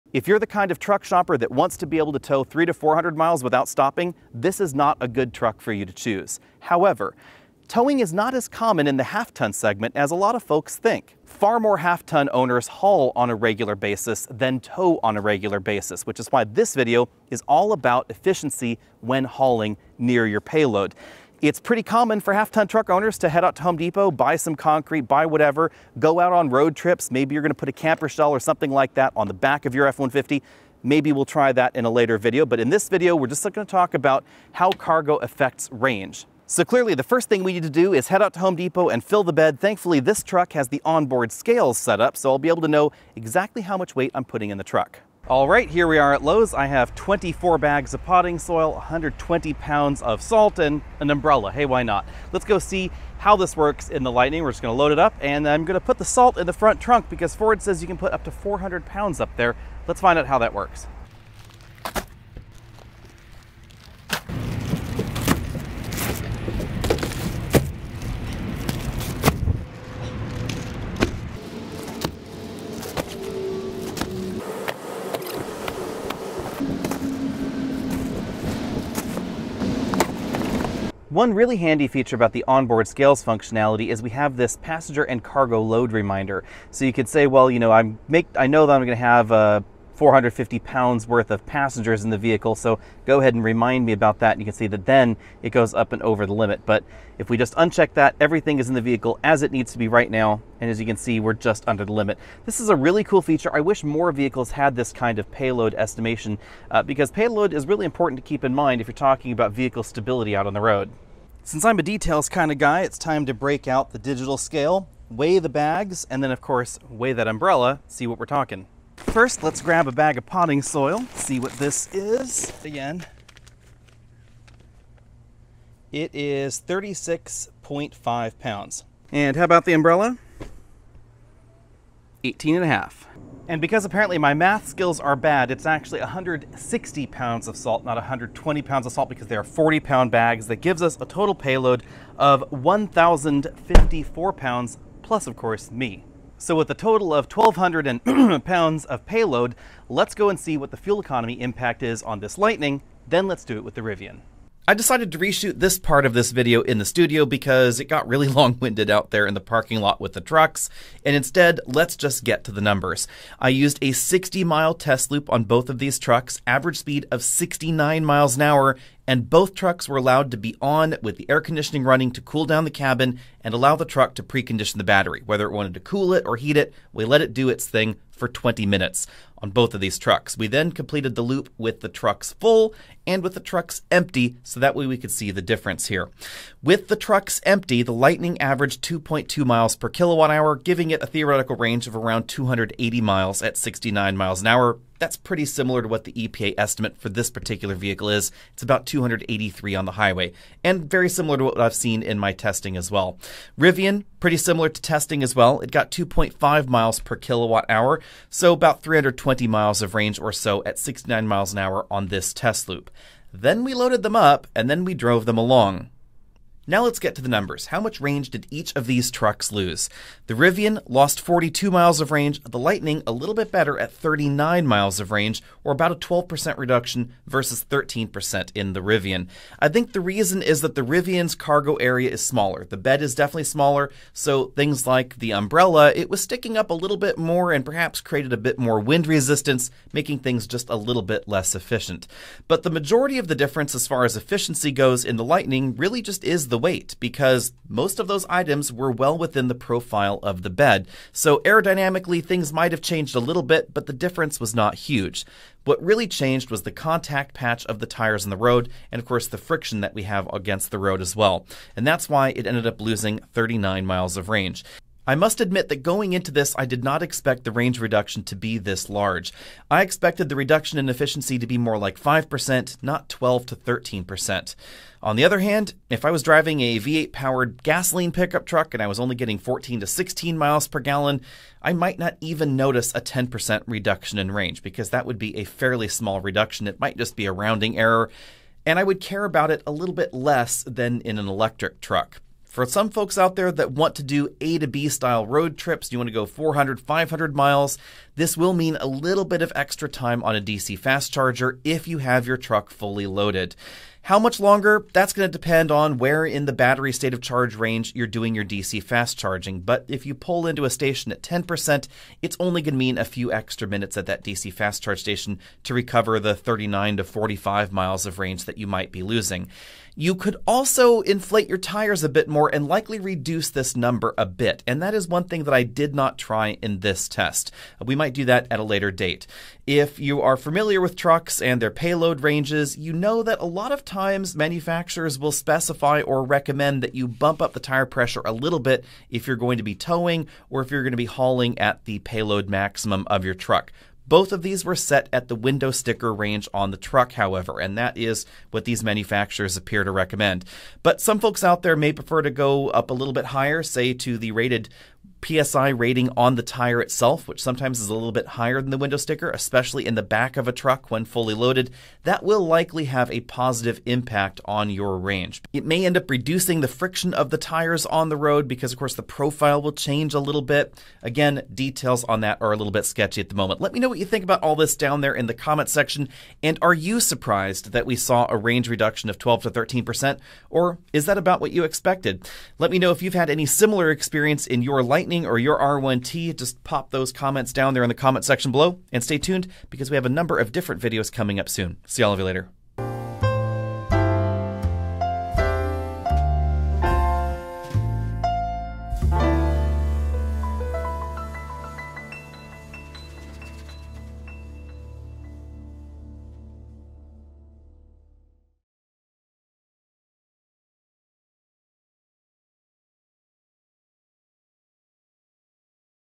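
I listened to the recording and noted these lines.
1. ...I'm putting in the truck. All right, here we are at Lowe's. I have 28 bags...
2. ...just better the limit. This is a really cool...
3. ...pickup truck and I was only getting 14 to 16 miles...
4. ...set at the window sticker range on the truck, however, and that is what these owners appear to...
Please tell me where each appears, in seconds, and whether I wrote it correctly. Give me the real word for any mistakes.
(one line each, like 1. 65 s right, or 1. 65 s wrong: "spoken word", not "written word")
1. 44 s wrong: "24", not "28"
2. 101 s wrong: "under", not "better"
3. 278 s right
4. 344 s wrong: "manufacturers", not "owners".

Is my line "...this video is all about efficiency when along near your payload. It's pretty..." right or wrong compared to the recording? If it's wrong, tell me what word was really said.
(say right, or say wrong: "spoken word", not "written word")
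wrong: "hauling", not "along".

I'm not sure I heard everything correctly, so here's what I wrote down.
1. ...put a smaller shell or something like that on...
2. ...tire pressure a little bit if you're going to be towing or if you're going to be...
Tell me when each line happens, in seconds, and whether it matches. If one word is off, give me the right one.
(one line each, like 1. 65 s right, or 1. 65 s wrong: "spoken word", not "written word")
1. 27 s wrong: "camper", not "smaller"
2. 337 s right.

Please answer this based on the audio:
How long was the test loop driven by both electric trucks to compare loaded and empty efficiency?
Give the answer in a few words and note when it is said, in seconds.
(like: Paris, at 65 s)
60 miles, at 163 s.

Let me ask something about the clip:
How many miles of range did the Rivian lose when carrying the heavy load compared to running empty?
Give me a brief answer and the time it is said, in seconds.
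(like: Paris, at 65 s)
42 miles, at 221 s.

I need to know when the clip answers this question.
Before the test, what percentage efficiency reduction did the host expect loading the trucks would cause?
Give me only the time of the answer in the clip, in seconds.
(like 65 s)
271 s.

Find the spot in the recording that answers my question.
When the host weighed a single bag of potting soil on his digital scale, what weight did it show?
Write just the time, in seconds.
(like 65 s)
126 s.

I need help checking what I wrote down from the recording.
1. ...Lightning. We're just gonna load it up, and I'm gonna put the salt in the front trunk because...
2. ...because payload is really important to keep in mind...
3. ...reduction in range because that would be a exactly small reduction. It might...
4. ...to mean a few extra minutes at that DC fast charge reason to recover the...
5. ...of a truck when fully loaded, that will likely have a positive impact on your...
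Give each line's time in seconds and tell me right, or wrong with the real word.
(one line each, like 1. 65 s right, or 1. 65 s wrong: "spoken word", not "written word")
1. 54 s right
2. 106 s right
3. 283 s wrong: "fairly", not "exactly"
4. 312 s wrong: "station", not "reason"
5. 360 s right.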